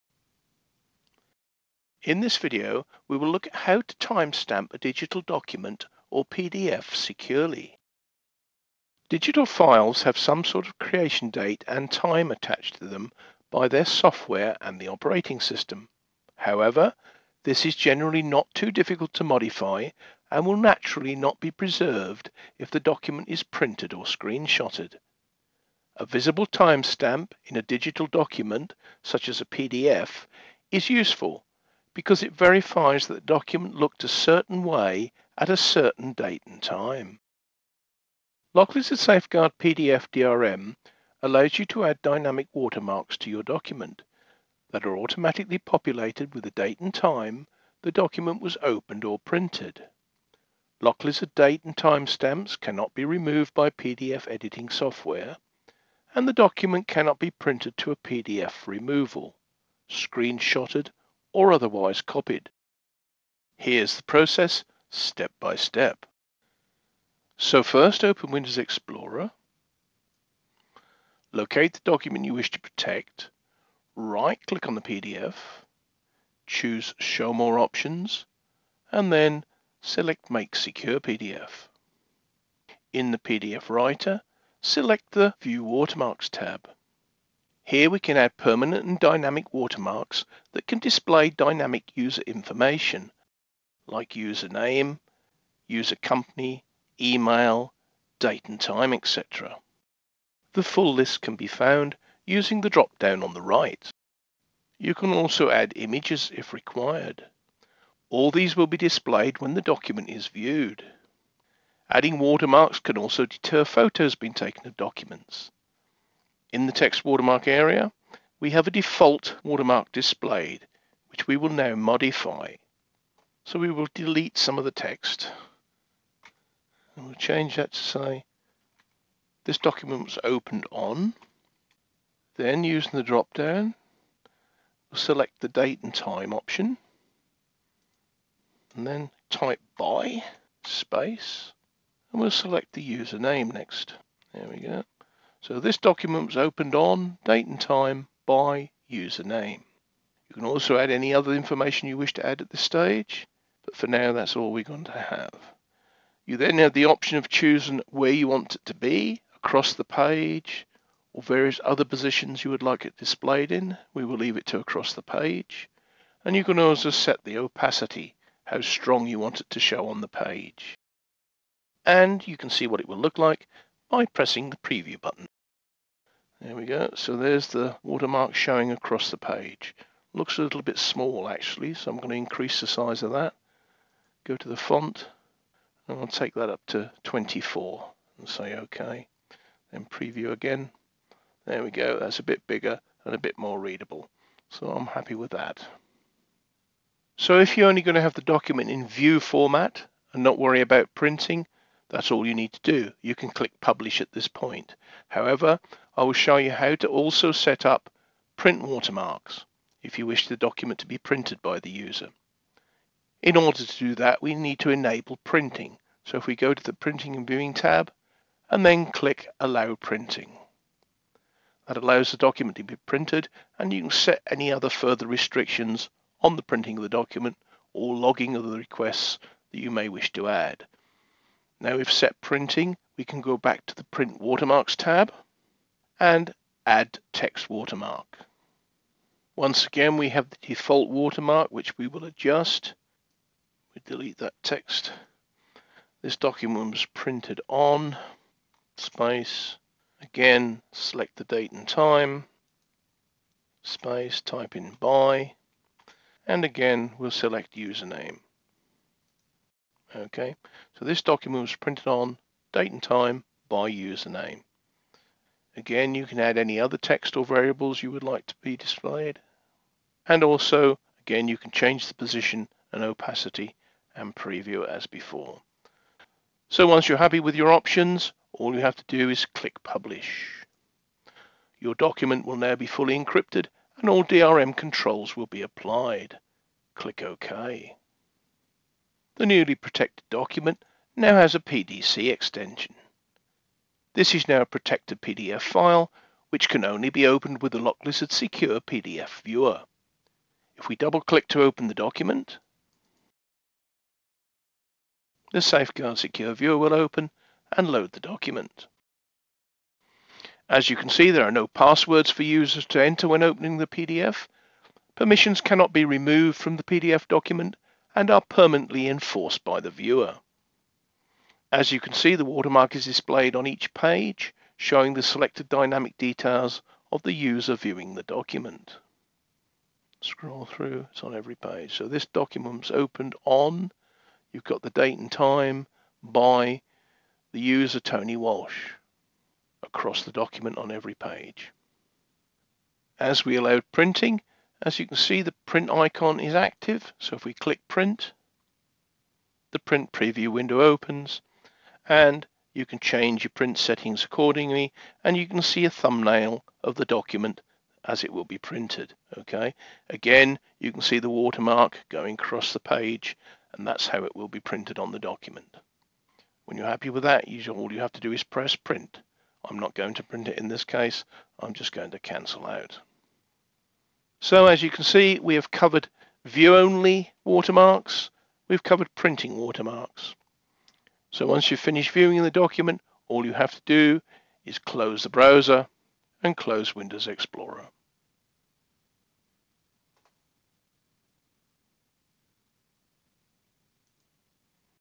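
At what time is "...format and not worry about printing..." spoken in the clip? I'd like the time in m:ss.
3:19.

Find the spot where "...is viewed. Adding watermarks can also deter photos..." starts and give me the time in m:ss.
1:50.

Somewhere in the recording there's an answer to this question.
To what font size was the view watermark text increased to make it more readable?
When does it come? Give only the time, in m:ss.
3:07.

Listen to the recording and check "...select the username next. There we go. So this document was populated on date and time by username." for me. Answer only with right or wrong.
wrong.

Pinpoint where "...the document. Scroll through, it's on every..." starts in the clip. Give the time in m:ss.
5:27.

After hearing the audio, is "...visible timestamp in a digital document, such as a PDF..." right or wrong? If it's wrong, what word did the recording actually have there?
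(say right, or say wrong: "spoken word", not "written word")
right.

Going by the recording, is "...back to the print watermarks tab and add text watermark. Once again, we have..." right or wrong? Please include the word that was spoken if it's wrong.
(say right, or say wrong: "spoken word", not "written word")
right.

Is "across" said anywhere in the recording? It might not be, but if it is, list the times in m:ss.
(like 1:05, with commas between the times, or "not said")
2:39, 2:44, 2:58, 5:39, 6:02.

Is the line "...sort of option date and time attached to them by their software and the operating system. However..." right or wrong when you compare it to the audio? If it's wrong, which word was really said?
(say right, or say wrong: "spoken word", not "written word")
wrong: "creation", not "option".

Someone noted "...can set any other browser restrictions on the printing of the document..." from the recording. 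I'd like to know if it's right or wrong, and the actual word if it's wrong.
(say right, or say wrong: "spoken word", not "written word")
wrong: "further", not "browser".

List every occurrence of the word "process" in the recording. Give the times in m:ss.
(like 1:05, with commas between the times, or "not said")
1:04.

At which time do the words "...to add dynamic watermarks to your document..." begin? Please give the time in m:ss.
0:41.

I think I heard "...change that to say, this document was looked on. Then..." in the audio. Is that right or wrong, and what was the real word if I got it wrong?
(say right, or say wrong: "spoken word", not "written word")
wrong: "opened", not "looked".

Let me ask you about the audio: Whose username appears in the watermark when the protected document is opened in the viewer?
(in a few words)
Tony Walsh.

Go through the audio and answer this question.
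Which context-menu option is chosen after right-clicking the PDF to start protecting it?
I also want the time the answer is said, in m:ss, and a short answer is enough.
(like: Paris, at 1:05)
Make Secure PDF, at 1:20.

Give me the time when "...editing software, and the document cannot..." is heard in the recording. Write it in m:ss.
0:54.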